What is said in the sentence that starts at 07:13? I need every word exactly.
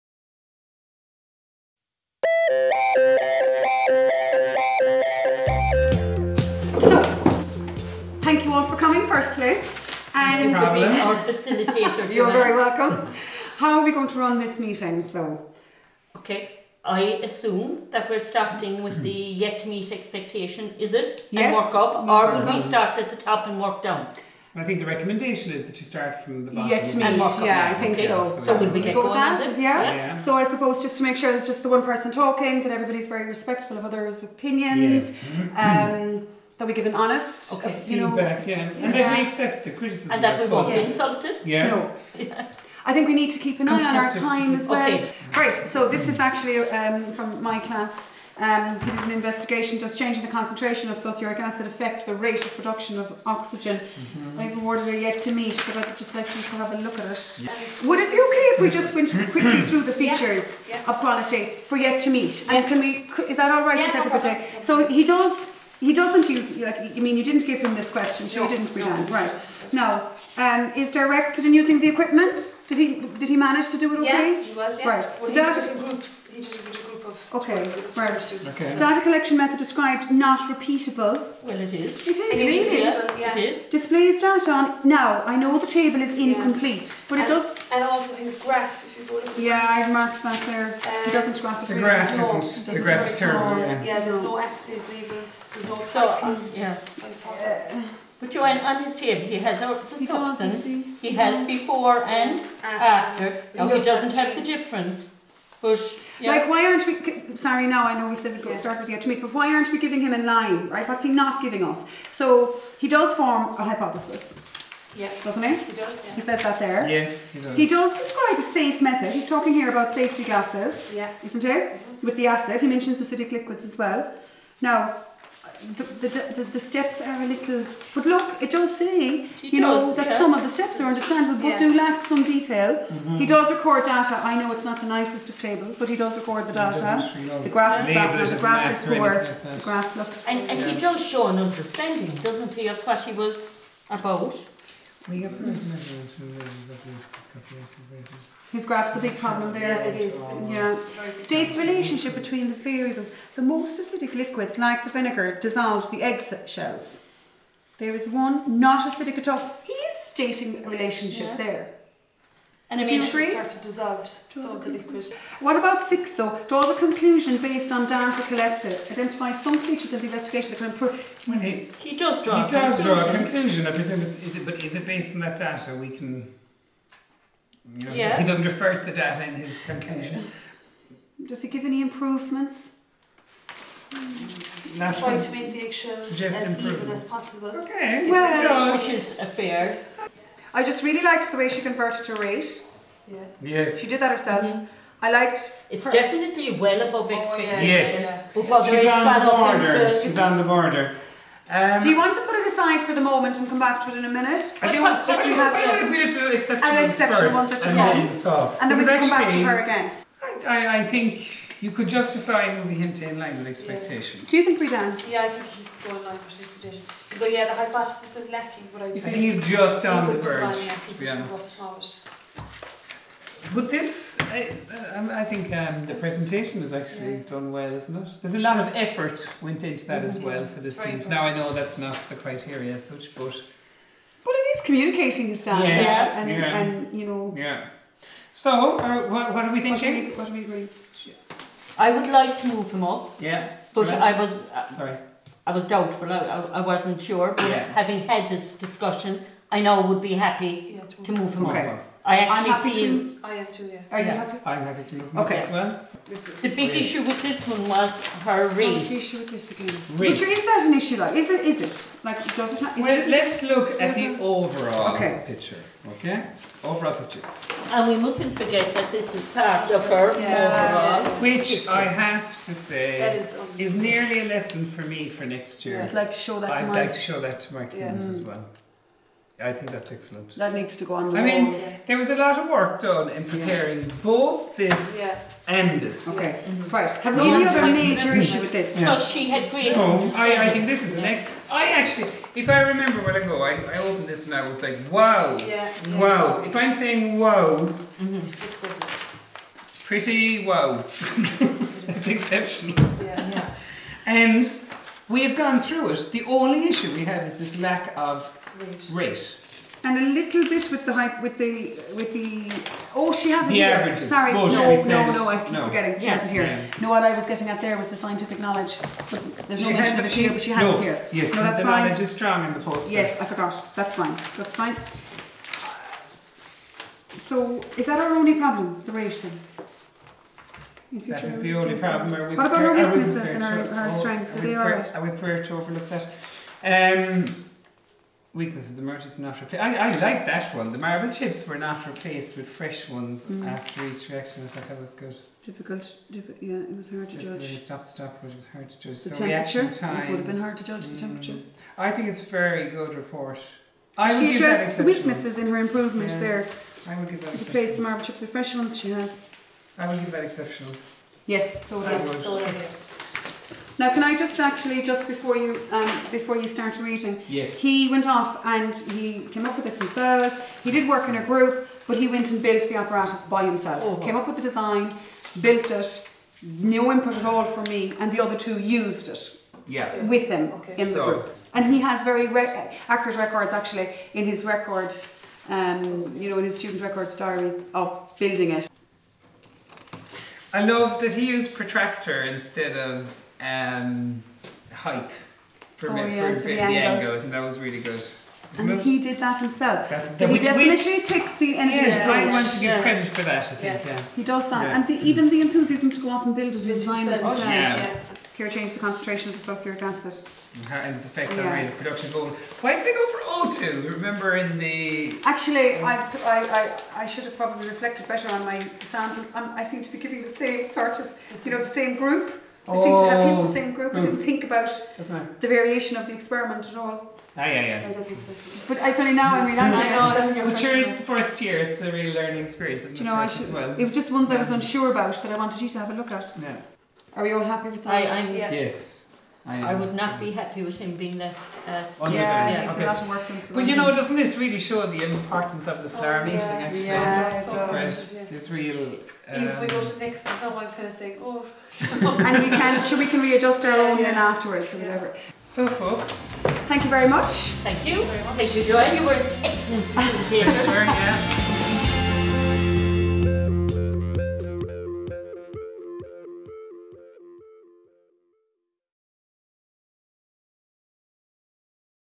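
It was just ones I was unsure about that I wanted you to have a look at.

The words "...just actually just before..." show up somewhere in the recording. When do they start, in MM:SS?
06:04.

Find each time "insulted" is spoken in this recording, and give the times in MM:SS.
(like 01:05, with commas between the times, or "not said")
00:40.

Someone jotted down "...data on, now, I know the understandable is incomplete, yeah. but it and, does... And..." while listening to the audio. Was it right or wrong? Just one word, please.
wrong.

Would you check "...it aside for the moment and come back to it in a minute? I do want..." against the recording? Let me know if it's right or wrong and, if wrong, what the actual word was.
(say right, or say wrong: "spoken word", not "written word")
right.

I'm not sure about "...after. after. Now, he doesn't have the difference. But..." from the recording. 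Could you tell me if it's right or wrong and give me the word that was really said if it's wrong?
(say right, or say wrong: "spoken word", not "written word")
right.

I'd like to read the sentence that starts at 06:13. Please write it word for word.
Oh, Came up with the design, built it, no input at all from me, and the other two used it.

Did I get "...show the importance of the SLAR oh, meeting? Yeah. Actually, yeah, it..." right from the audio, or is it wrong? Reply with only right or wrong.
right.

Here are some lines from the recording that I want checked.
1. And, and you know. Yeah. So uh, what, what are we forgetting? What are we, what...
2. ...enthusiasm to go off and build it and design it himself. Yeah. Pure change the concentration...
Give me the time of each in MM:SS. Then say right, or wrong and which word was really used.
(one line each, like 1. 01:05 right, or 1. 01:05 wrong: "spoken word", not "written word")
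1. 03:56 wrong: "thinking", not "forgetting"
2. 06:45 right.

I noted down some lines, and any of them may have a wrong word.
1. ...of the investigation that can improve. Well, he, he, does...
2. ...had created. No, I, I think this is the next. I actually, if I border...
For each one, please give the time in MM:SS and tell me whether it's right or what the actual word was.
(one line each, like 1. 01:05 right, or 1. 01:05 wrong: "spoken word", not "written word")
1. 02:49 right
2. 04:49 wrong: "remember", not "border".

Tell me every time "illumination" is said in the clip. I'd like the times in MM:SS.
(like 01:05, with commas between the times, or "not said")
not said.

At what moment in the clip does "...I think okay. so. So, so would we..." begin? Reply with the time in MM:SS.
00:27.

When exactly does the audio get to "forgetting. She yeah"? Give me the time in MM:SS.
05:15.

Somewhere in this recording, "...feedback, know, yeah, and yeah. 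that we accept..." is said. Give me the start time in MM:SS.
00:38.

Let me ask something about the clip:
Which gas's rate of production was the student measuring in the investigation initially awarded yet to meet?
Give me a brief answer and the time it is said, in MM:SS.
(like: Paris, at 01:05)
oxygen, at 00:53.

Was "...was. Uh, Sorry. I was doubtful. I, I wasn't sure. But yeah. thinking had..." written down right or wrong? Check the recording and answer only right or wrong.
wrong.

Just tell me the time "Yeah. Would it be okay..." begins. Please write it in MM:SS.
00:57.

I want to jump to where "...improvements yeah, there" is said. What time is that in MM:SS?
05:55.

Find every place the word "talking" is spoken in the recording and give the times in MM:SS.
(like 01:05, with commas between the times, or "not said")
00:32, 01:59.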